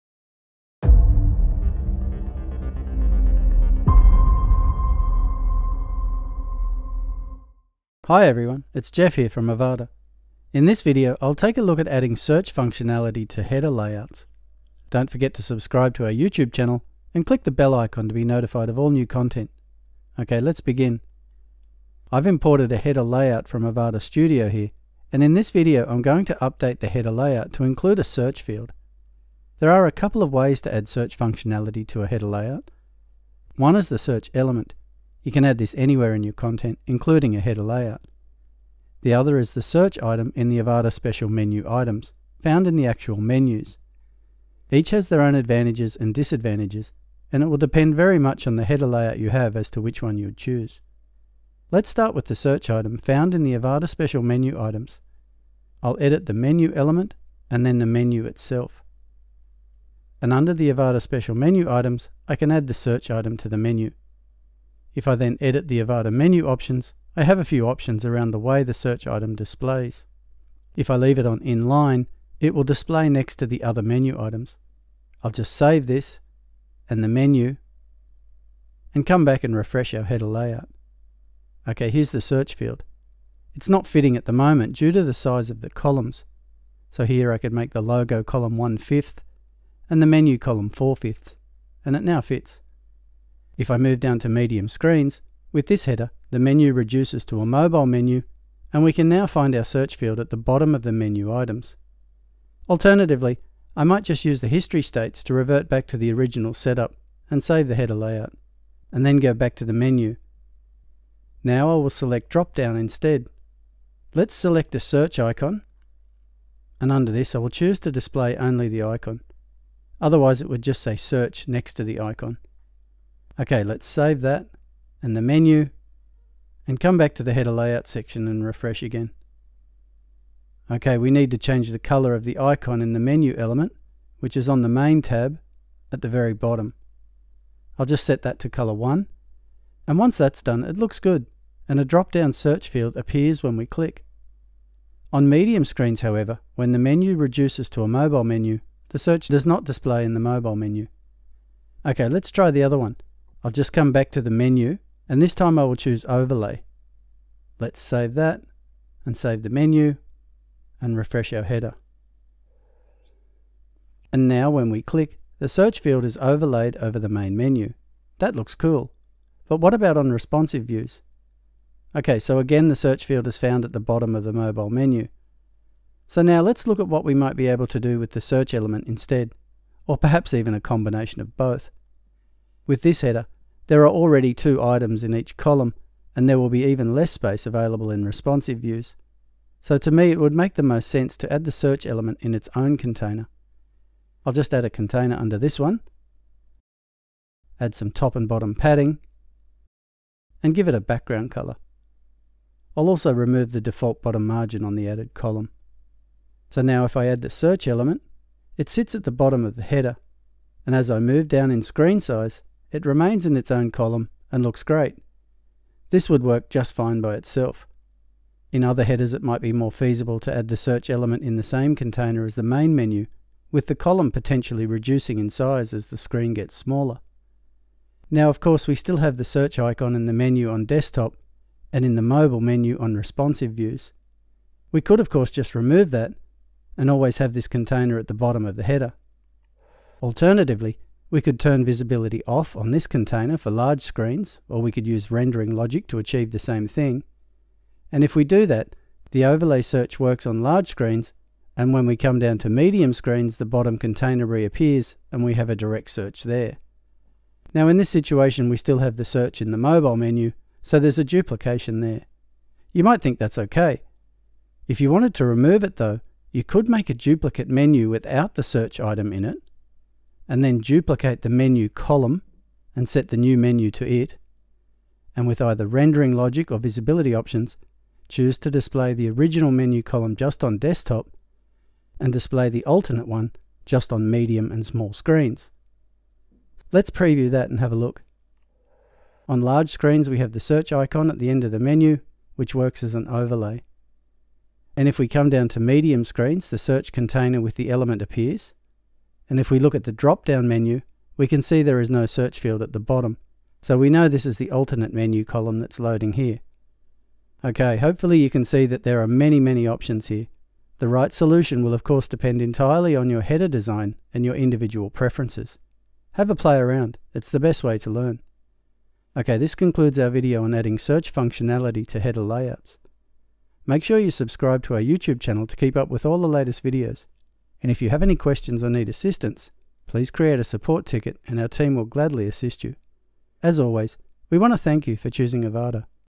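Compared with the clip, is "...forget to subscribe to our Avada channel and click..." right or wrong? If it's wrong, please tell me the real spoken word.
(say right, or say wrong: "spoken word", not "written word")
wrong: "YouTube", not "Avada".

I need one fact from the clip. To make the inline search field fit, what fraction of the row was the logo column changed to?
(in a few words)
1/5.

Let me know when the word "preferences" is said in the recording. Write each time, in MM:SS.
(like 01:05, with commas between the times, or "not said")
05:14.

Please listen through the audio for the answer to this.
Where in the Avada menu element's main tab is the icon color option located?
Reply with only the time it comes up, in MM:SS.
02:15.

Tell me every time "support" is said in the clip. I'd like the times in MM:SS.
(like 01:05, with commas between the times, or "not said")
05:30.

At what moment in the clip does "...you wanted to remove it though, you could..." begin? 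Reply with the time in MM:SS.
04:24.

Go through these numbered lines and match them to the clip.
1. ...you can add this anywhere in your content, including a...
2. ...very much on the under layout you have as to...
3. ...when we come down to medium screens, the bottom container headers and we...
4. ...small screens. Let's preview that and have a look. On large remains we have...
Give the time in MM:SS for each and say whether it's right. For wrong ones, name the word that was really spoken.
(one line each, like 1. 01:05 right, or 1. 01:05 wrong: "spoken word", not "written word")
1. 00:35 right
2. 00:47 wrong: "header", not "under"
3. 04:11 wrong: "reappears", not "headers"
4. 04:44 wrong: "screens", not "remains".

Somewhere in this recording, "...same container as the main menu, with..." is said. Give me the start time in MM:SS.
03:41.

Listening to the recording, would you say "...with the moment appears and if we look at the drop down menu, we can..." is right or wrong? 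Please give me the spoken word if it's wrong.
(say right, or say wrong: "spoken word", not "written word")
wrong: "element", not "moment".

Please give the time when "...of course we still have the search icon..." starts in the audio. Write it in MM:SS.
03:48.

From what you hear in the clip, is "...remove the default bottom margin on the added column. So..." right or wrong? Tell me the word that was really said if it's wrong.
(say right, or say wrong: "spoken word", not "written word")
right.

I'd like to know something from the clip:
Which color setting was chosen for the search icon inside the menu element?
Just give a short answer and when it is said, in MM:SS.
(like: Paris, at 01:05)
color 1, at 02:18.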